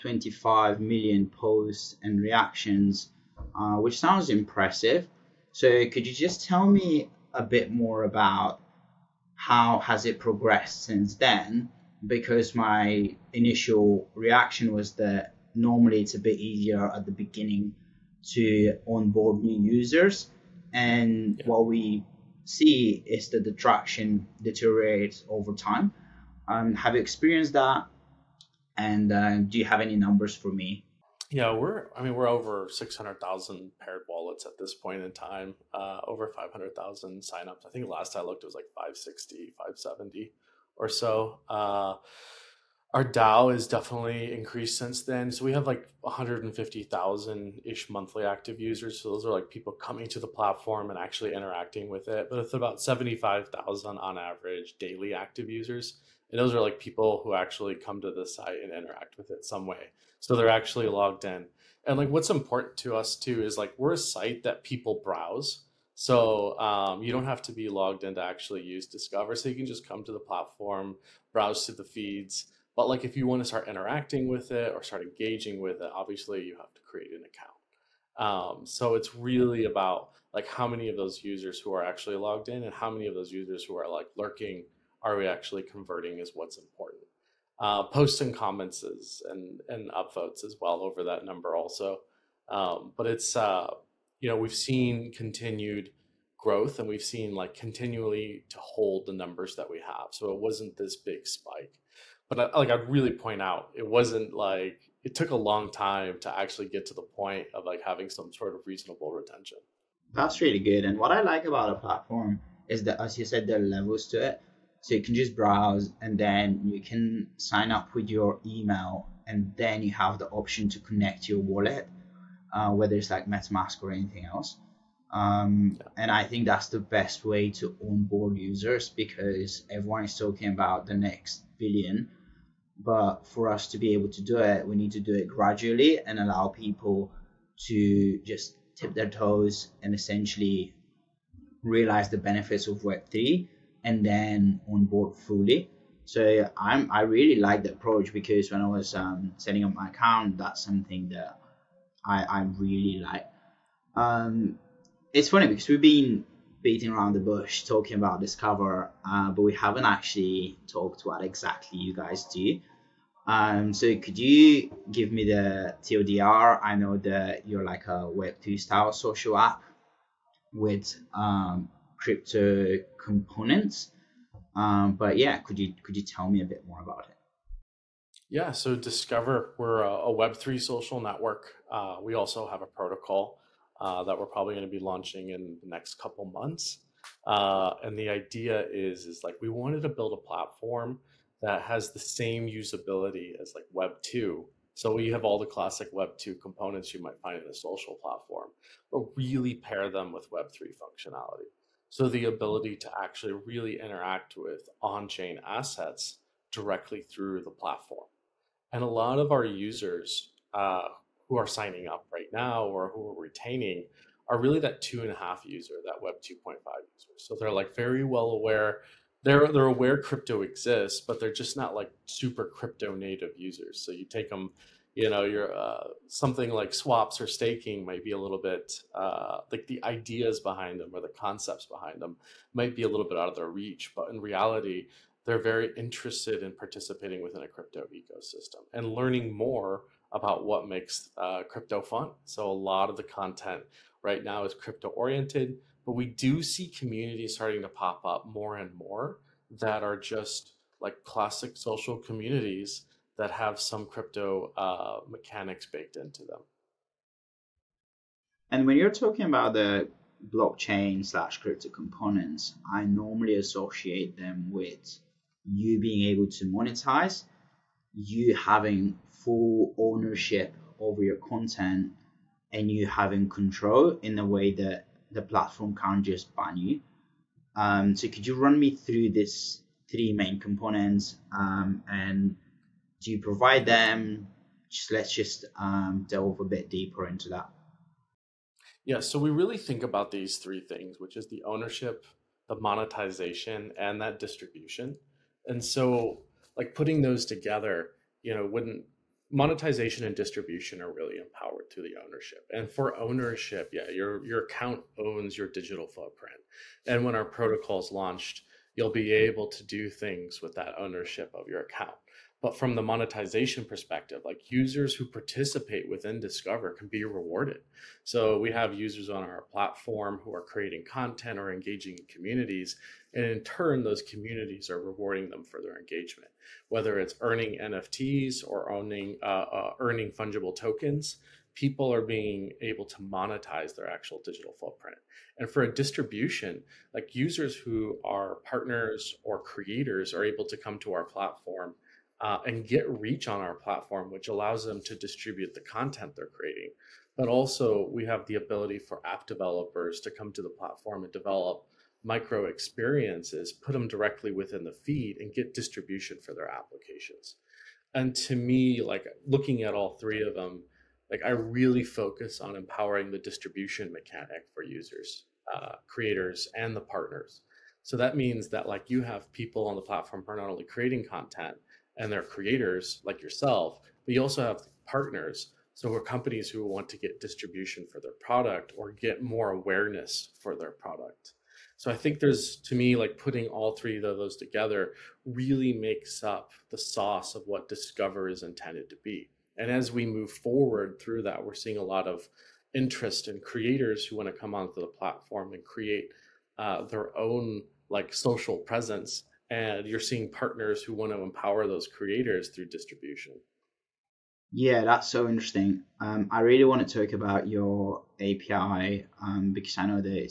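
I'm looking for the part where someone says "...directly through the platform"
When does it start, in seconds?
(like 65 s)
206 s.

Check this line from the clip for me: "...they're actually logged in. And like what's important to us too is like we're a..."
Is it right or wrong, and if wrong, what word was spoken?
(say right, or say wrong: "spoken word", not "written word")
right.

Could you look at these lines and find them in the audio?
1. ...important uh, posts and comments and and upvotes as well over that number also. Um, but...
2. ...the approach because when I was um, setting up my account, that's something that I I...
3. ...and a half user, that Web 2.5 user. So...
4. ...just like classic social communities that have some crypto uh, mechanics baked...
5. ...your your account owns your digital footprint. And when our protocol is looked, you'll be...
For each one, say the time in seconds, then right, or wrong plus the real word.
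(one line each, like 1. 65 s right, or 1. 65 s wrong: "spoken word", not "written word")
1. 86 s right
2. 147 s right
3. 215 s right
4. 249 s right
5. 303 s wrong: "launched", not "looked".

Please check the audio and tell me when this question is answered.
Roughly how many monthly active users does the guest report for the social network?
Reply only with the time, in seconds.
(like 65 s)
46 s.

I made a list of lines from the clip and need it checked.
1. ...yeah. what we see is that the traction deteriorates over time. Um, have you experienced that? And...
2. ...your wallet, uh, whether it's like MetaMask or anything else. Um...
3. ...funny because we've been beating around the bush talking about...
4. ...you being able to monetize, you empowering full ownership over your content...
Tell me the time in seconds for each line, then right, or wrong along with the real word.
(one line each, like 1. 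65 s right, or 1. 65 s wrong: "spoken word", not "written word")
1. 21 s right
2. 121 s right
3. 155 s right
4. 265 s wrong: "having", not "empowering".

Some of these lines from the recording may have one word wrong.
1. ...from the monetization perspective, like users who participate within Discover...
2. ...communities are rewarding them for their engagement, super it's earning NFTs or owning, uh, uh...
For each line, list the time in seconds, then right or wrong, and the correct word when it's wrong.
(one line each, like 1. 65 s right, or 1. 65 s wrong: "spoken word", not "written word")
1. 312 s right
2. 324 s wrong: "whether", not "super".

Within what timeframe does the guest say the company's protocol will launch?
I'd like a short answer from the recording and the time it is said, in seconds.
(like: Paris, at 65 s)
next couple months, at 185 s.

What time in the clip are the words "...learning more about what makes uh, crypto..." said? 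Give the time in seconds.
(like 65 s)
238 s.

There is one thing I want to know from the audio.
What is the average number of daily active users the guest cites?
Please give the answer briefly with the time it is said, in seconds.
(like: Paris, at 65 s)
75,000, at 52 s.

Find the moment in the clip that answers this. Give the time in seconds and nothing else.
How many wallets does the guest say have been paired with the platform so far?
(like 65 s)
32 s.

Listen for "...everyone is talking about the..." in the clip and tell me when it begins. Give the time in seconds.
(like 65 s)
129 s.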